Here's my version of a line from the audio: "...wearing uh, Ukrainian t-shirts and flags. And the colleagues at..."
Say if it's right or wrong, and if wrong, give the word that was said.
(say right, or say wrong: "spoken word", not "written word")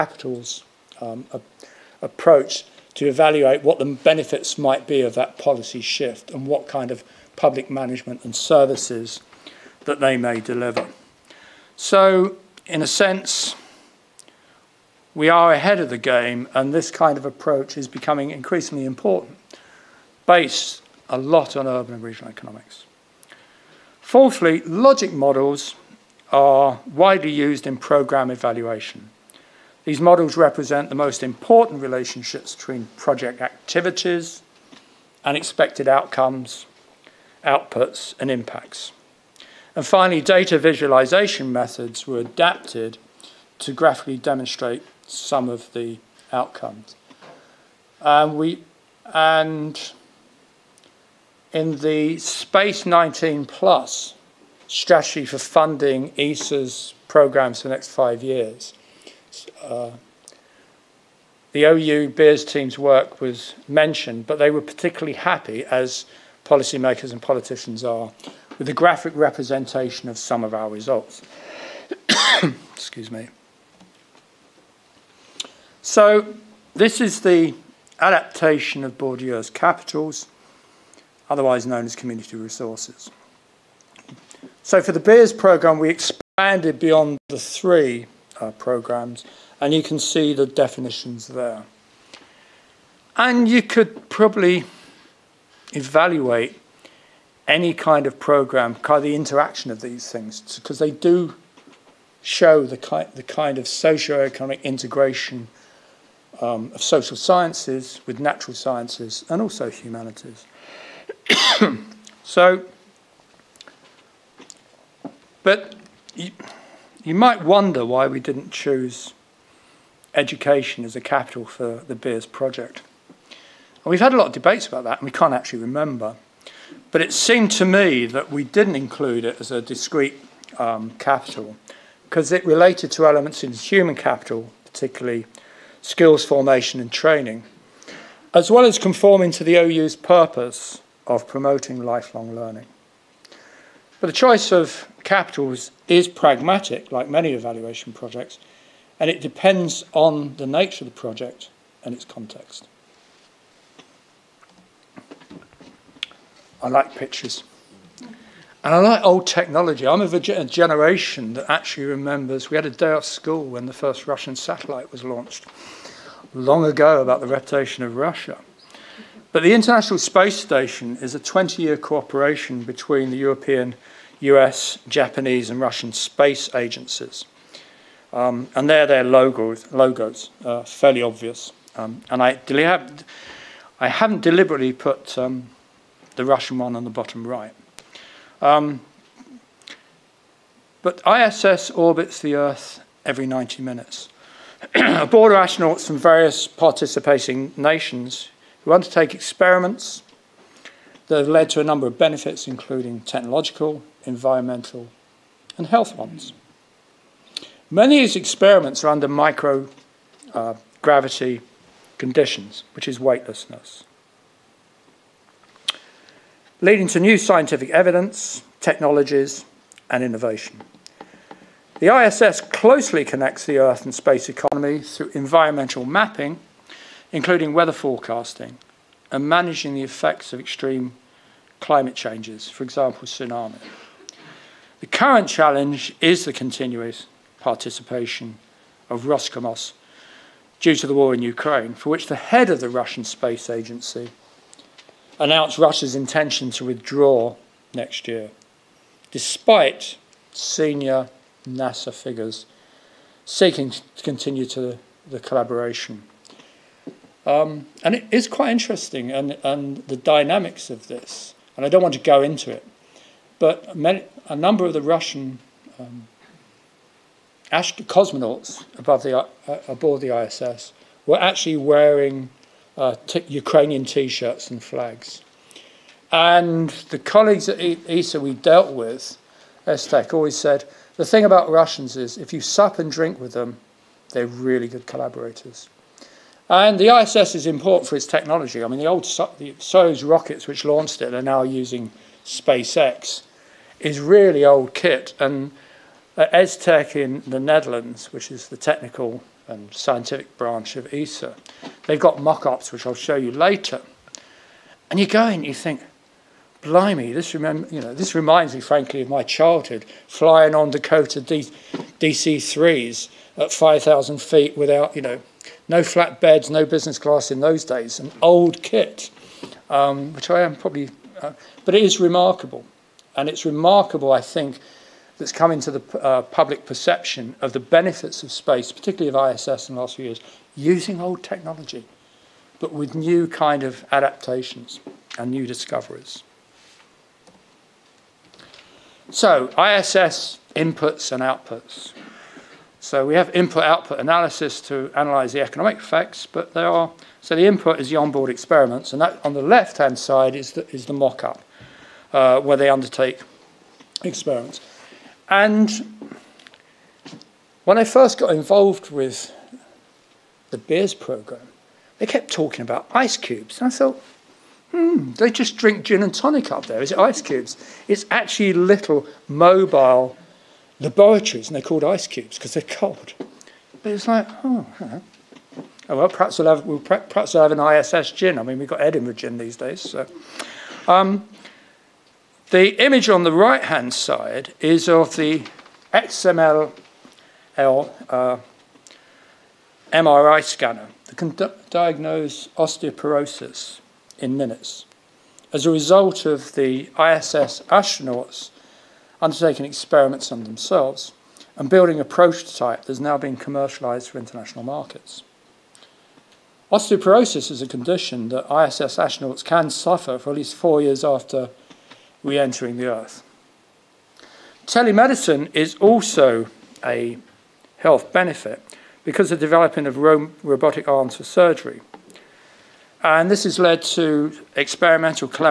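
right.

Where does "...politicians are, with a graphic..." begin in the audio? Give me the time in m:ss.
1:07.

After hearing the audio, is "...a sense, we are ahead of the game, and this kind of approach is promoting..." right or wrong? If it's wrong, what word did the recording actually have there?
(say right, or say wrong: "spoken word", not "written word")
wrong: "becoming", not "promoting".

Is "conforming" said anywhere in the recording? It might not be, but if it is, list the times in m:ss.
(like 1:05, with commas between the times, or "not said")
2:18.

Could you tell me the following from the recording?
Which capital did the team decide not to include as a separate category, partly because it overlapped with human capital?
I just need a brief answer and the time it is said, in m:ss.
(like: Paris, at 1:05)
education, at 2:00.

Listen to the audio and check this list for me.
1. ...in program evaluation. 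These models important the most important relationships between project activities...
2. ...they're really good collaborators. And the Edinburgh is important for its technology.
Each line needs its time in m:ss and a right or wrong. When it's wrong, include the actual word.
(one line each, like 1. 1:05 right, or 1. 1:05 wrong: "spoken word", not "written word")
1. 0:27 wrong: "represent", not "important"
2. 4:44 wrong: "ISS", not "Edinburgh".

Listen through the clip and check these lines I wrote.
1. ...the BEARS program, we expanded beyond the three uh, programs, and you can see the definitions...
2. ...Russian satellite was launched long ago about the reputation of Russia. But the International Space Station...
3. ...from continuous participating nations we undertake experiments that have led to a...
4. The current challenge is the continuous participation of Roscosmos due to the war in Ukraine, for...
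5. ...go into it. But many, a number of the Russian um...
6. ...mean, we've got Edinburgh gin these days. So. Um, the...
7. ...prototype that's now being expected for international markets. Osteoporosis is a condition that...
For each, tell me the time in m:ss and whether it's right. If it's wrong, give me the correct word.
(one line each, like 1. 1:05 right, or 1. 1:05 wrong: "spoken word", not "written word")
1. 1:24 right
2. 2:44 right
3. 3:15 wrong: "various", not "continuous"
4. 3:54 right
5. 4:22 right
6. 6:18 right
7. 6:42 wrong: "commercialized", not "expected".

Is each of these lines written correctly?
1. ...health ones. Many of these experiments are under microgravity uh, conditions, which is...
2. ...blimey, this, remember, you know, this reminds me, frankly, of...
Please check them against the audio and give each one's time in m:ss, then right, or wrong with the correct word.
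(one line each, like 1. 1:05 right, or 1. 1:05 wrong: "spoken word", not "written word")
1. 3:25 right
2. 5:06 right.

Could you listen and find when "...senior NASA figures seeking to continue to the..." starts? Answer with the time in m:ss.
4:10.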